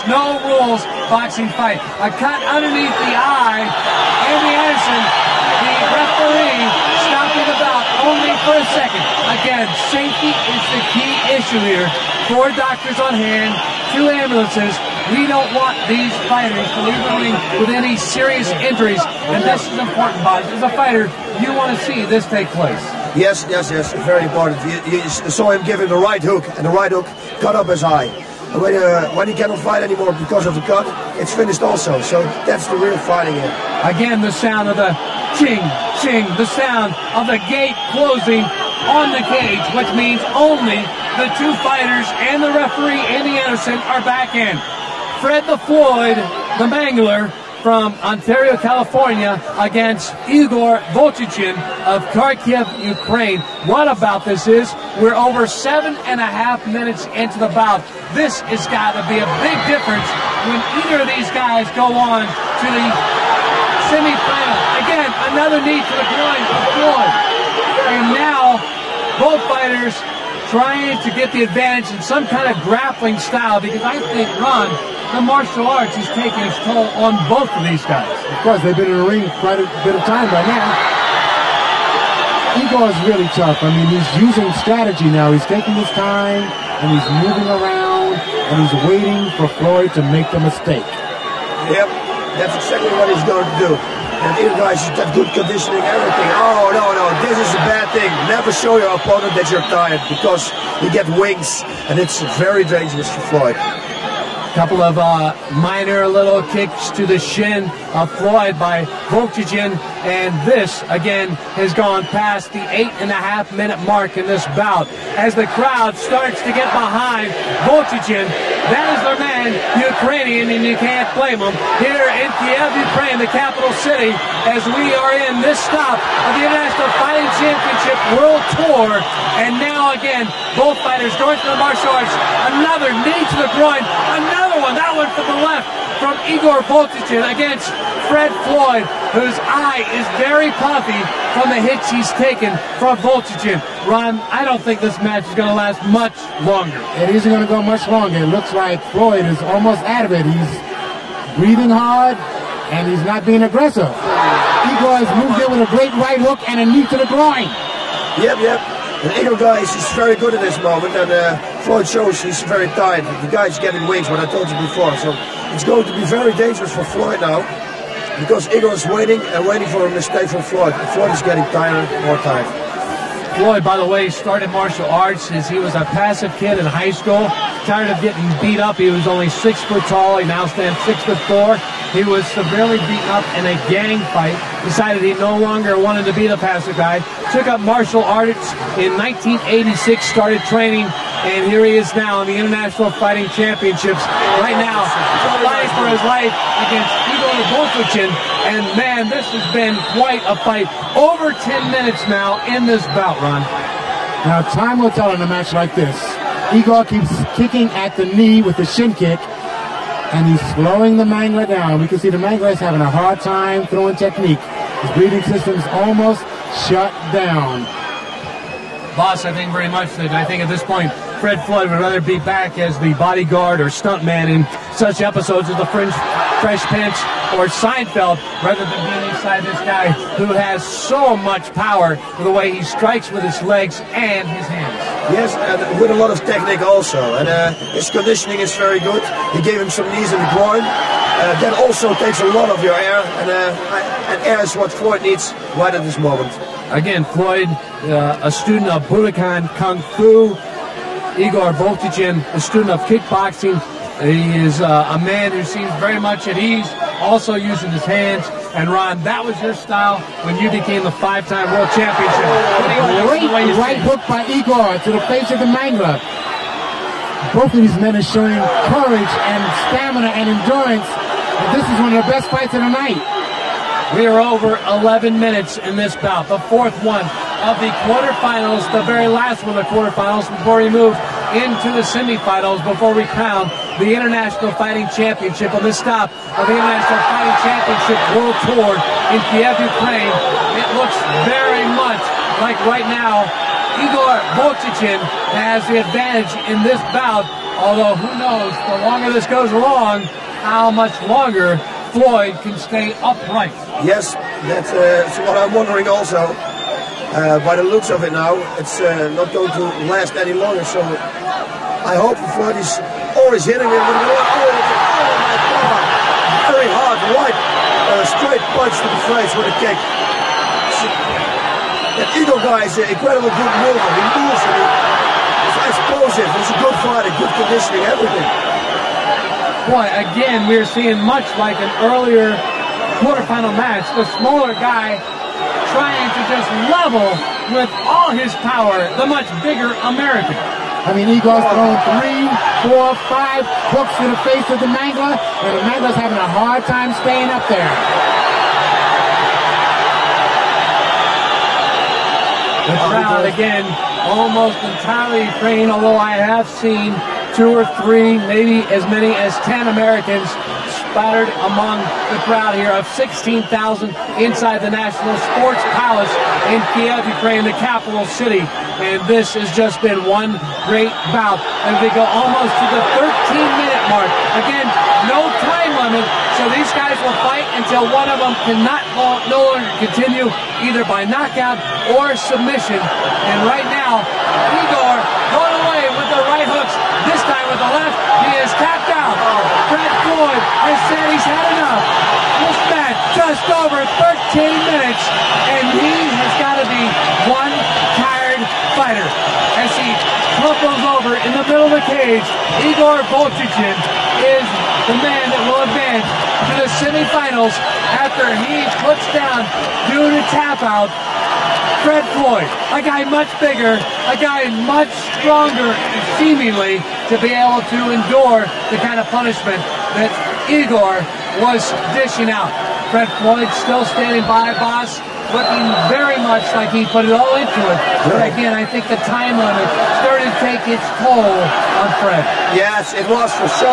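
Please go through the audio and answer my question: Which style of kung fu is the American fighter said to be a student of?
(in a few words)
Budokan Kung Fu.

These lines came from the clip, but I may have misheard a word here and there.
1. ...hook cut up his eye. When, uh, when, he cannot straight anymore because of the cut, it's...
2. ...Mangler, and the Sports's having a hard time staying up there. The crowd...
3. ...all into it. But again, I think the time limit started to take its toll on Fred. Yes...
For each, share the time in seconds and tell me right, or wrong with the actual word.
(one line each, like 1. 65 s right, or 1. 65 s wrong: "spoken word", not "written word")
1. 26 s wrong: "fight", not "straight"
2. 344 s wrong: "Mangler", not "Sports"
3. 427 s right.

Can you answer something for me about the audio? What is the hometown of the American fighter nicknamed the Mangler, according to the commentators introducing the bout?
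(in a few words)
Ontario, California.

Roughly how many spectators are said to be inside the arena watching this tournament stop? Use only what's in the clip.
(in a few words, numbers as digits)
16,000.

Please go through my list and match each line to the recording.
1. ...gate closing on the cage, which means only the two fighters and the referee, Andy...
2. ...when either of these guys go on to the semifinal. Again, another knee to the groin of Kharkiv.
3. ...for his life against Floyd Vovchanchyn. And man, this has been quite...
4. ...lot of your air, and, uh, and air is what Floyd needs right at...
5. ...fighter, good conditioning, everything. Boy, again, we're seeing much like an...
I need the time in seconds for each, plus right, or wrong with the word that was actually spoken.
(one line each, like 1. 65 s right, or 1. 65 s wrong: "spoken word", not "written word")
1. 37 s right
2. 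60 s wrong: "Floyd", not "Kharkiv"
3. 195 s wrong: "Igor", not "Floyd"
4. 242 s right
5. 326 s right.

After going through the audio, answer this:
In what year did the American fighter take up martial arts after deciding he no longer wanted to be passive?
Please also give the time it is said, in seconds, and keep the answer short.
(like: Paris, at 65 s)
1986, at 188 s.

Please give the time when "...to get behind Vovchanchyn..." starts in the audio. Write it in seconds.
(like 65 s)
116 s.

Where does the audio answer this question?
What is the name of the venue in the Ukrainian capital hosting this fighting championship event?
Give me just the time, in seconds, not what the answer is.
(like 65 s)
364 s.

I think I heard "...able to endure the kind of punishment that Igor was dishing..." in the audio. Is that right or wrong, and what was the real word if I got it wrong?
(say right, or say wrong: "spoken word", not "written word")
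right.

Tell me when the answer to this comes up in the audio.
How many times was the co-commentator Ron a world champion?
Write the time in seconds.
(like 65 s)
260 s.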